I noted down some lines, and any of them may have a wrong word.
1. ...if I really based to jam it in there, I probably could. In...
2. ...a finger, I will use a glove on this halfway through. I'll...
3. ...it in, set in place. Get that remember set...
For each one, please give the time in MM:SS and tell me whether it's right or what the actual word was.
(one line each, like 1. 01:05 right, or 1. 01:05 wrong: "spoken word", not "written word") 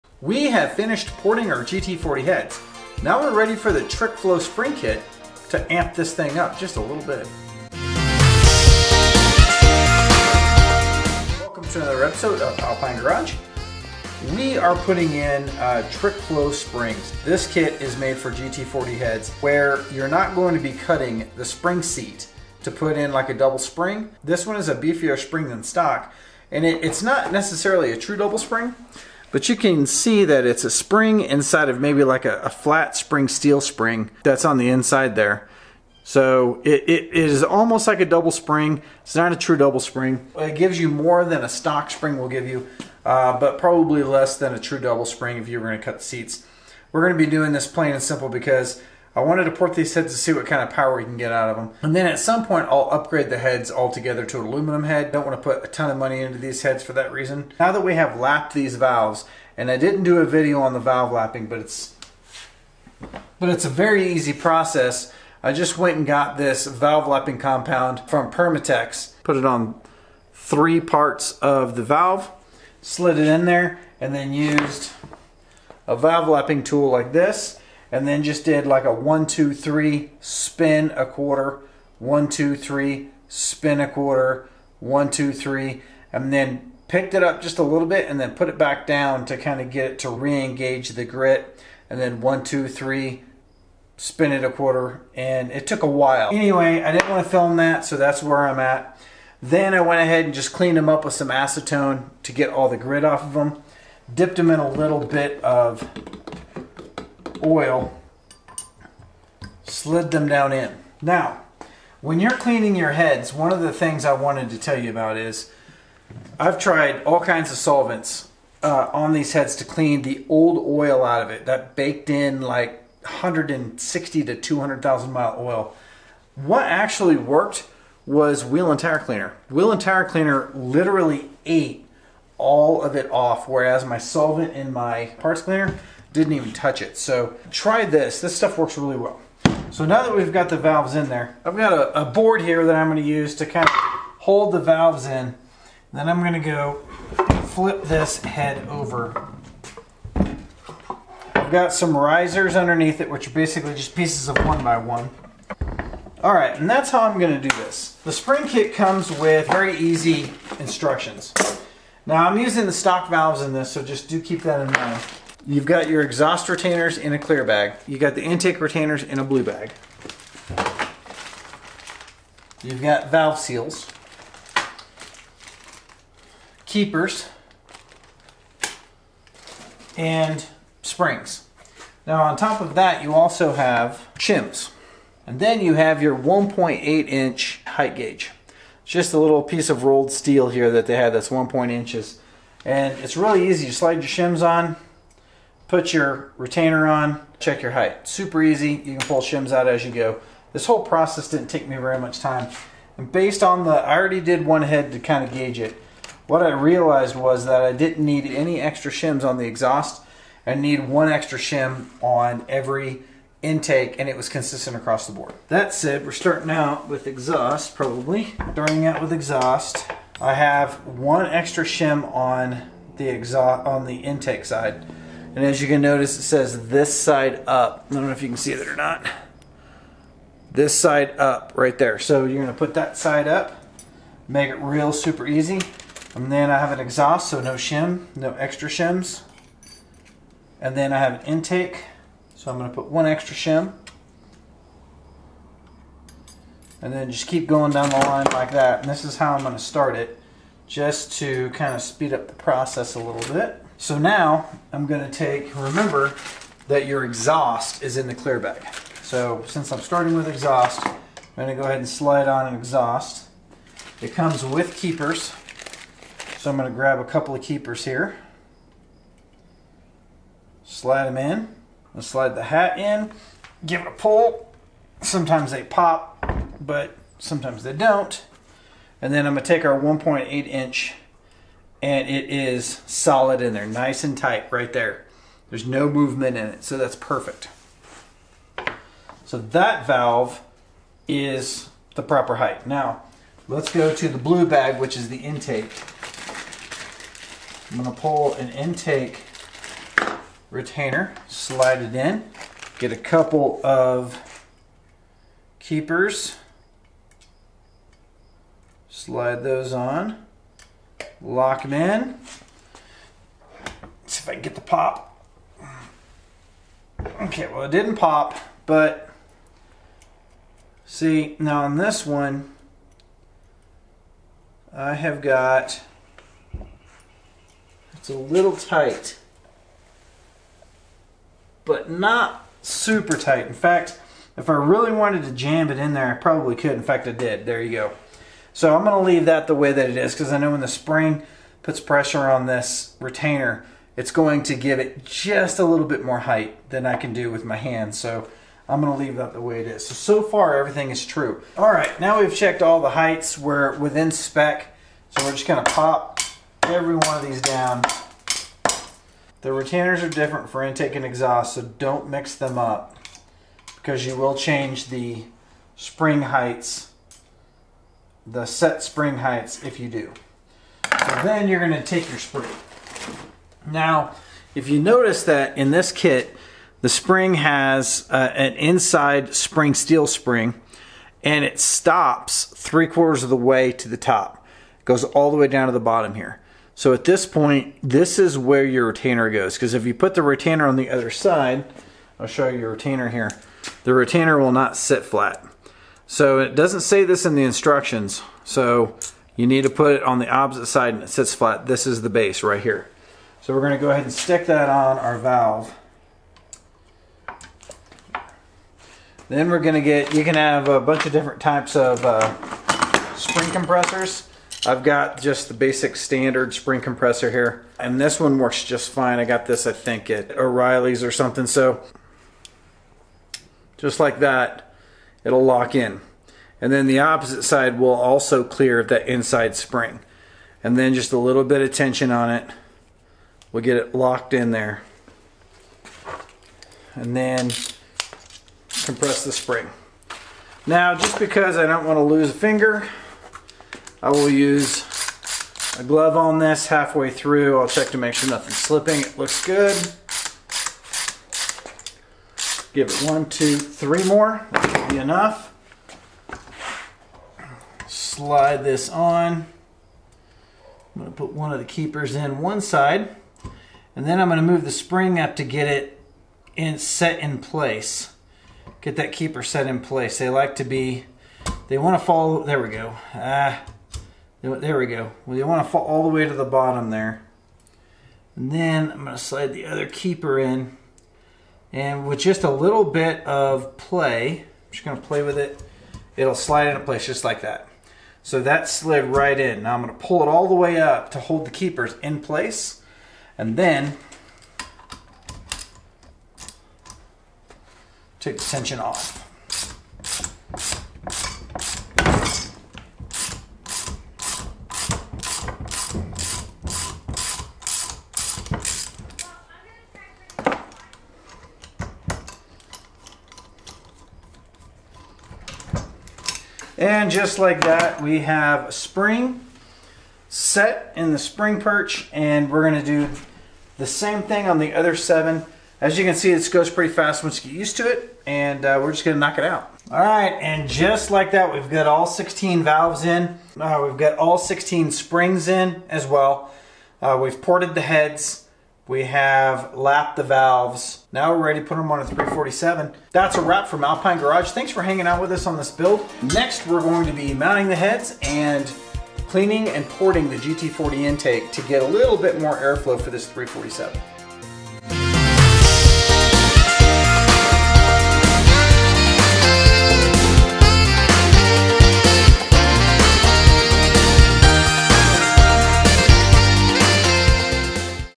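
1. 05:34 wrong: "wanted", not "based"
2. 07:22 right
3. 07:45 wrong: "keeper", not "remember".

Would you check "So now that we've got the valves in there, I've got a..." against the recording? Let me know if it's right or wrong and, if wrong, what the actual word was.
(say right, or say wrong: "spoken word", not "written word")
right.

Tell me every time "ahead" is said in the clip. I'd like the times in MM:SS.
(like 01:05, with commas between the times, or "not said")
01:39, 04:21, 06:43.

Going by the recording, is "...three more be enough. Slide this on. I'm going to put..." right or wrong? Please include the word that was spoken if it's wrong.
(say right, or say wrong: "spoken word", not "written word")
right.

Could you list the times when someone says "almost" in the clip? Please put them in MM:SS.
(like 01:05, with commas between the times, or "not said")
00:37.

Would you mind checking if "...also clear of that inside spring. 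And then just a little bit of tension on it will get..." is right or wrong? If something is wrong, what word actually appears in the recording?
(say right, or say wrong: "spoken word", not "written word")
right.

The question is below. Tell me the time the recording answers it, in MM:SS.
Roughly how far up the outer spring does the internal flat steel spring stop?
06:22.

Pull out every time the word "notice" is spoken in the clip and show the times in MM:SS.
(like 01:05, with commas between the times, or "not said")
03:45, 06:14.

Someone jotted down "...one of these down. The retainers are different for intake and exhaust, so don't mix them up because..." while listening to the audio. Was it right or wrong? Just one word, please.
right.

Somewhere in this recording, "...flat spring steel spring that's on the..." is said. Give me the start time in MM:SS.
00:32.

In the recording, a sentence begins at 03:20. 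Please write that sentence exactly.
This whole process didn't take me very much time.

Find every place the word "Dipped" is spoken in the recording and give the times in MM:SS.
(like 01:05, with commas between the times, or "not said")
01:44.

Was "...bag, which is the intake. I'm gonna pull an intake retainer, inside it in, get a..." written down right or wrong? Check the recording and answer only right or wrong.
wrong.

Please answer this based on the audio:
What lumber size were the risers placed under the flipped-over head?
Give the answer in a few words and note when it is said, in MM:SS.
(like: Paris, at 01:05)
one by one, at 02:34.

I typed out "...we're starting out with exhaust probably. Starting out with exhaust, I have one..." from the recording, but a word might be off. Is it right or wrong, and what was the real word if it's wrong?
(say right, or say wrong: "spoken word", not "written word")
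right.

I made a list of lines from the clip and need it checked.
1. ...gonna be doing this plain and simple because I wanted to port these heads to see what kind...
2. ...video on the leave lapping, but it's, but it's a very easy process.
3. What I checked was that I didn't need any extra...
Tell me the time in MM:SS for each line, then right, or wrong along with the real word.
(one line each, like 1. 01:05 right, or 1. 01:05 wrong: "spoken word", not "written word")
1. 00:47 right
2. 01:00 wrong: "valve", not "leave"
3. 03:26 wrong: "realized", not "checked".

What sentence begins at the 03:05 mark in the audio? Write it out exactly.
And then you have your 1.8 inch height gauge.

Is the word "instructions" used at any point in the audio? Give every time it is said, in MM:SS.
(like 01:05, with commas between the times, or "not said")
02:40, 06:37.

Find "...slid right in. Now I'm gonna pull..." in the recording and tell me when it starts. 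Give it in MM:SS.
08:08.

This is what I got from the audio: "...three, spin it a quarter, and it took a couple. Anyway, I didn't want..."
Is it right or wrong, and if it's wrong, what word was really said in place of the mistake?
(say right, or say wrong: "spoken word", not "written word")
wrong: "while", not "couple".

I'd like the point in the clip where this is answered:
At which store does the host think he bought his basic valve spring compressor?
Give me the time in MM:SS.
07:00.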